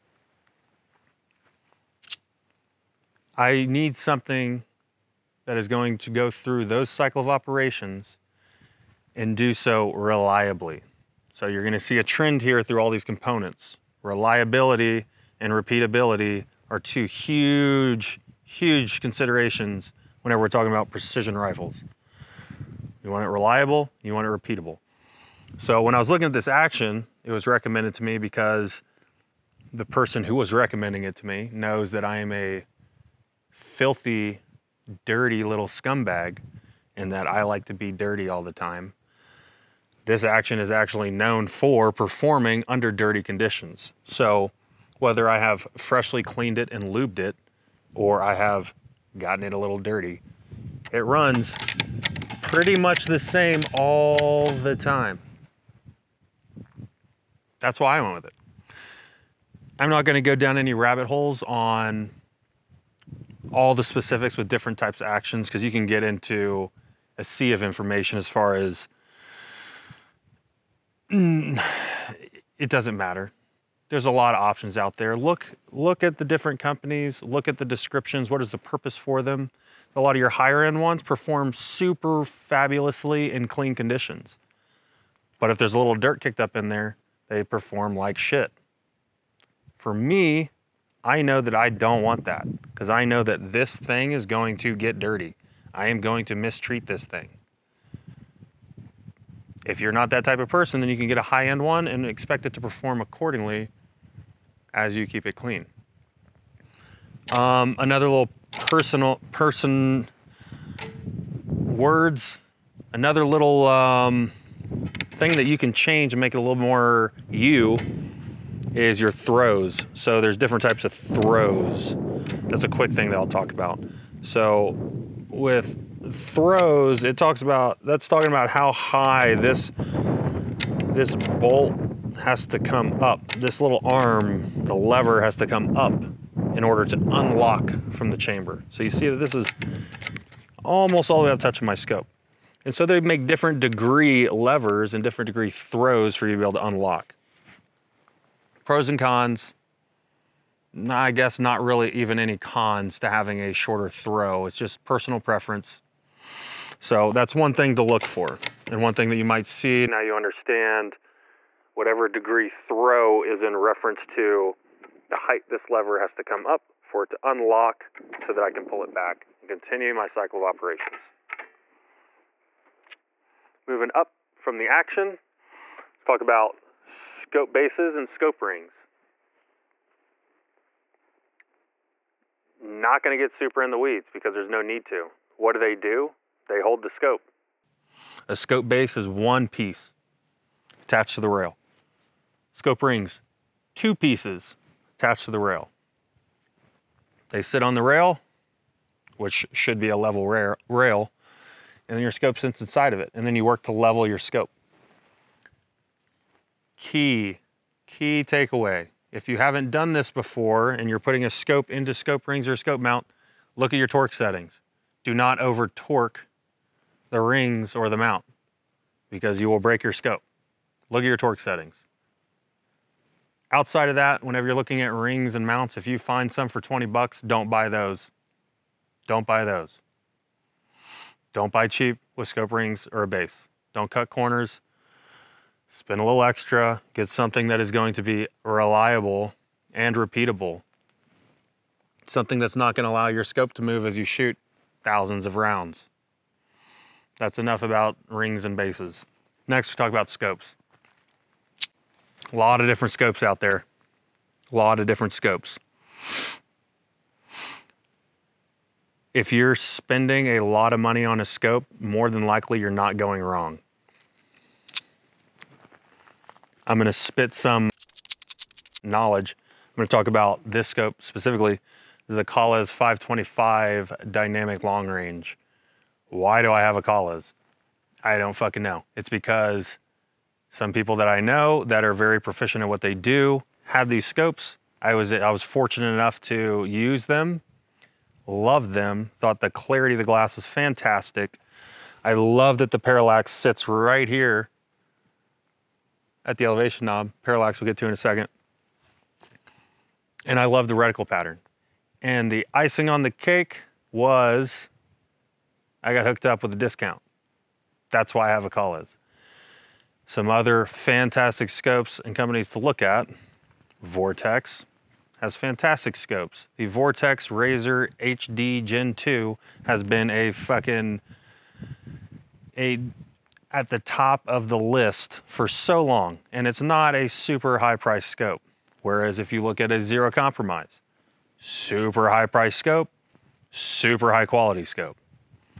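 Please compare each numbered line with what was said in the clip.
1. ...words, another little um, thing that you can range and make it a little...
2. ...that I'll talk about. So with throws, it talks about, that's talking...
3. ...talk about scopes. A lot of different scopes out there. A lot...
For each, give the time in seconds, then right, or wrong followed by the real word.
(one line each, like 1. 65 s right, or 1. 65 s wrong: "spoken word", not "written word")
1. 111 s wrong: "change", not "range"
2. 123 s right
3. 249 s right.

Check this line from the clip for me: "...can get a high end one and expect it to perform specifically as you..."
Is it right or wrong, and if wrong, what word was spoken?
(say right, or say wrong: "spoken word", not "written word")
wrong: "accordingly", not "specifically".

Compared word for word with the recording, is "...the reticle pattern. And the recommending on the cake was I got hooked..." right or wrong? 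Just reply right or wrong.
wrong.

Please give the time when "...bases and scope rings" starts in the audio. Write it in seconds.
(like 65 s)
177 s.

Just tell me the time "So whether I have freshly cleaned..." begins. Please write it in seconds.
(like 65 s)
44 s.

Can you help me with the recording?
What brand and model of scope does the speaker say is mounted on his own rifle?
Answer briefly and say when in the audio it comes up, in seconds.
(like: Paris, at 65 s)
Kahles 525, at 272 s.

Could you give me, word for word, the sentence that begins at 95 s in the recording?
I am going to mistreat this thing.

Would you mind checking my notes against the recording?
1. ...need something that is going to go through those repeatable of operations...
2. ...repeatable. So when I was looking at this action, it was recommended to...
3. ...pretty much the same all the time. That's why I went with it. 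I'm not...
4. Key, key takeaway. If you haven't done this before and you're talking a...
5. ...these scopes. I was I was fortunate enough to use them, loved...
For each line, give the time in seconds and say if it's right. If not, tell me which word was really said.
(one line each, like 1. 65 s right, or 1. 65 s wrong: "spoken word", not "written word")
1. 3 s wrong: "cycle", not "repeatable"
2. 24 s right
3. 52 s right
4. 206 s wrong: "putting", not "talking"
5. 283 s right.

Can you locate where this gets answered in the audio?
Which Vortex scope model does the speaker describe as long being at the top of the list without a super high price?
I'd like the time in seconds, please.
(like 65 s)
317 s.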